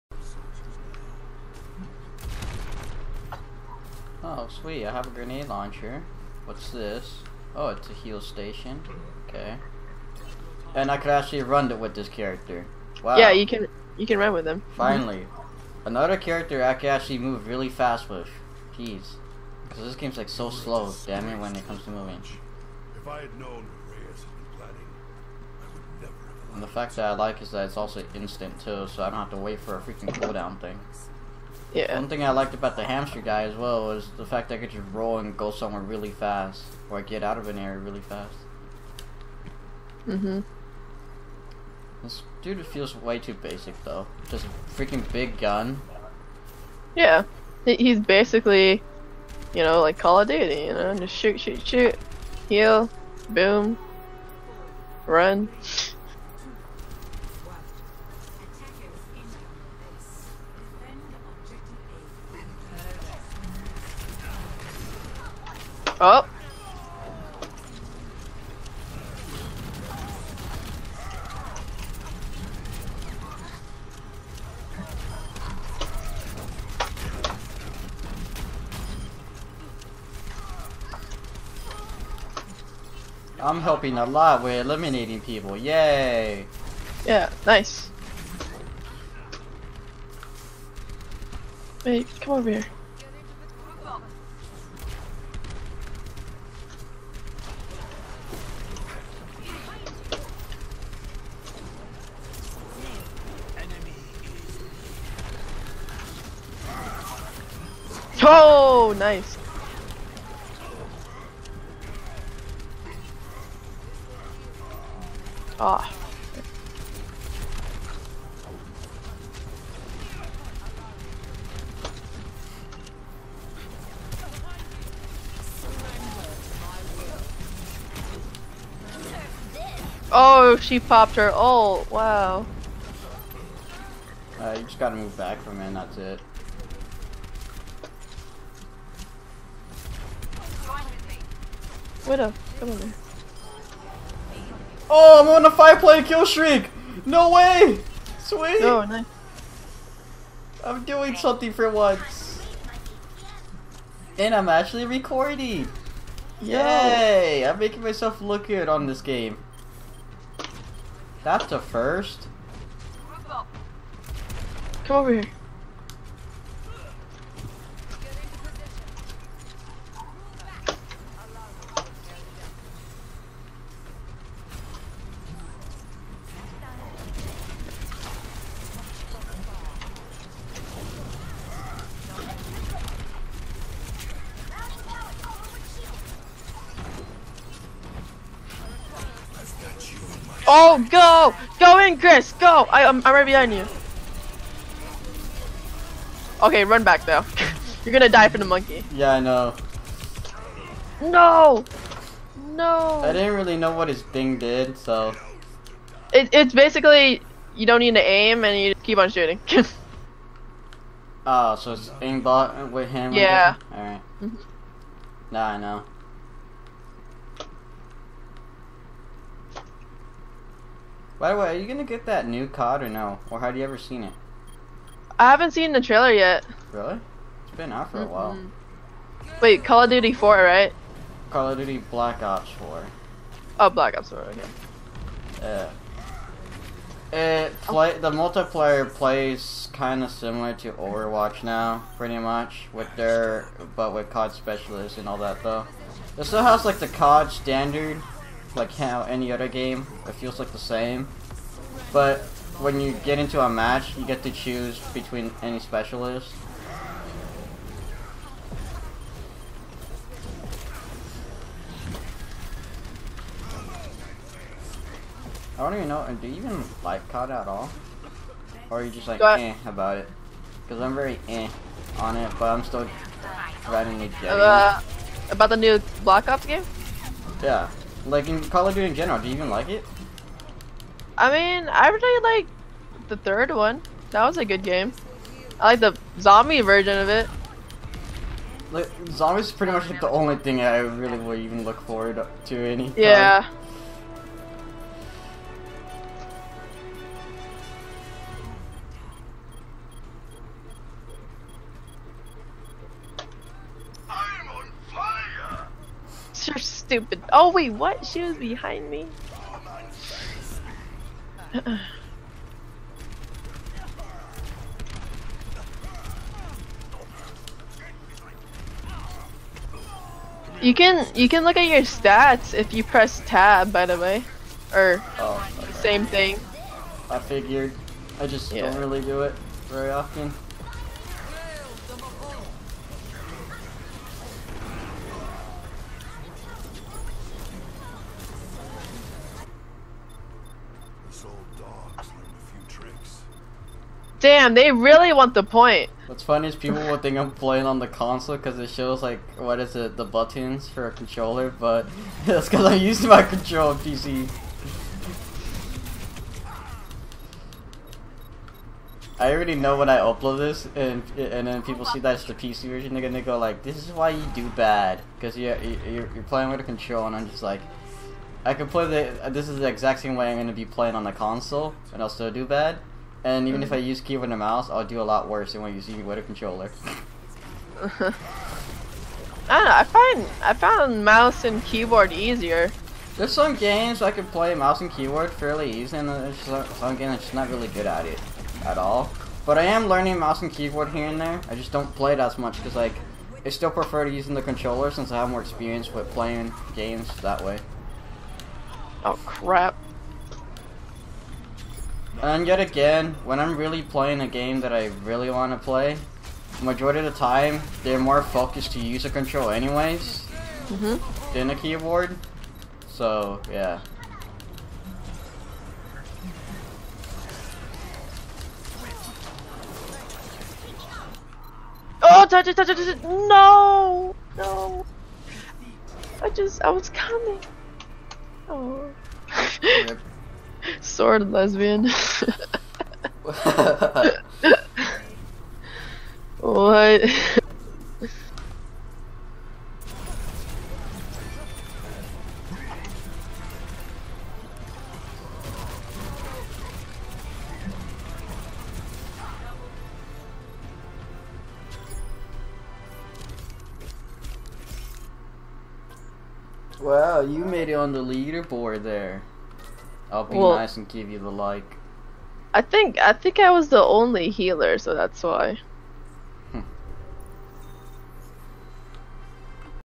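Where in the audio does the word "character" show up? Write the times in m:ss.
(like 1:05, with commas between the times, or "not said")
0:12, 0:16.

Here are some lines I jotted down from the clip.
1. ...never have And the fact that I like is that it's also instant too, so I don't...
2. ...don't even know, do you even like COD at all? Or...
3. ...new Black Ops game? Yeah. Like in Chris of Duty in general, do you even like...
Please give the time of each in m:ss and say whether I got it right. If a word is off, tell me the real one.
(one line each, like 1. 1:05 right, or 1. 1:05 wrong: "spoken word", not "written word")
1. 0:26 right
2. 4:25 right
3. 4:35 wrong: "Call", not "Chris".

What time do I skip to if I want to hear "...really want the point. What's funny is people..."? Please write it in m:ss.
5:44.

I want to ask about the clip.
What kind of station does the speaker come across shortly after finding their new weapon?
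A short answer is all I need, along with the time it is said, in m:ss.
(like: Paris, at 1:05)
Heal station, at 0:07.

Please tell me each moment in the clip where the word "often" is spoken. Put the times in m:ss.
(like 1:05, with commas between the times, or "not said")
5:29.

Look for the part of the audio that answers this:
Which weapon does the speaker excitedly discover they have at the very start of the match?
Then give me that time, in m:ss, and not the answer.
0:05.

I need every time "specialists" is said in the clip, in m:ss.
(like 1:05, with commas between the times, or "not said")
4:04, 4:15.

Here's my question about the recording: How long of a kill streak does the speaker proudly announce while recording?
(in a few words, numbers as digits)
5.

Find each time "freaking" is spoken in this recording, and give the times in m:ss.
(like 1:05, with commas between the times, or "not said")
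0:29, 0:44.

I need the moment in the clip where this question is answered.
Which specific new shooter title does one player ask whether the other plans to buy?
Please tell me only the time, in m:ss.
3:51.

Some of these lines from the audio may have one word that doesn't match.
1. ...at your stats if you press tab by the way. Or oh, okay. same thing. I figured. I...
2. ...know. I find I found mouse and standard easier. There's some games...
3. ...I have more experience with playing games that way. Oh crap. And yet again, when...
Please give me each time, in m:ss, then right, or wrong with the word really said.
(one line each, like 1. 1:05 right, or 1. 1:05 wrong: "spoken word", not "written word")
1. 5:21 right
2. 6:19 wrong: "keyboard", not "standard"
3. 6:35 right.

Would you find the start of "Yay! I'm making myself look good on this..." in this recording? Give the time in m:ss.
2:36.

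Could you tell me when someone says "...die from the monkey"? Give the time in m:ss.
3:18.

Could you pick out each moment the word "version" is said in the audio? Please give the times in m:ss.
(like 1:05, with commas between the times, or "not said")
4:46, 6:02.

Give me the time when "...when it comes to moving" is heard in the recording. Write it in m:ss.
0:21.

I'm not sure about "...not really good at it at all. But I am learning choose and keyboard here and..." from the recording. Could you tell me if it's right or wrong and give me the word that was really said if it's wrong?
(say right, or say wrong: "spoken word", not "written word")
wrong: "mouse", not "choose".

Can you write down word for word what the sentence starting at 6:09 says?
This is the exact same way I'm going to be playing on the console, and I'll still do bad.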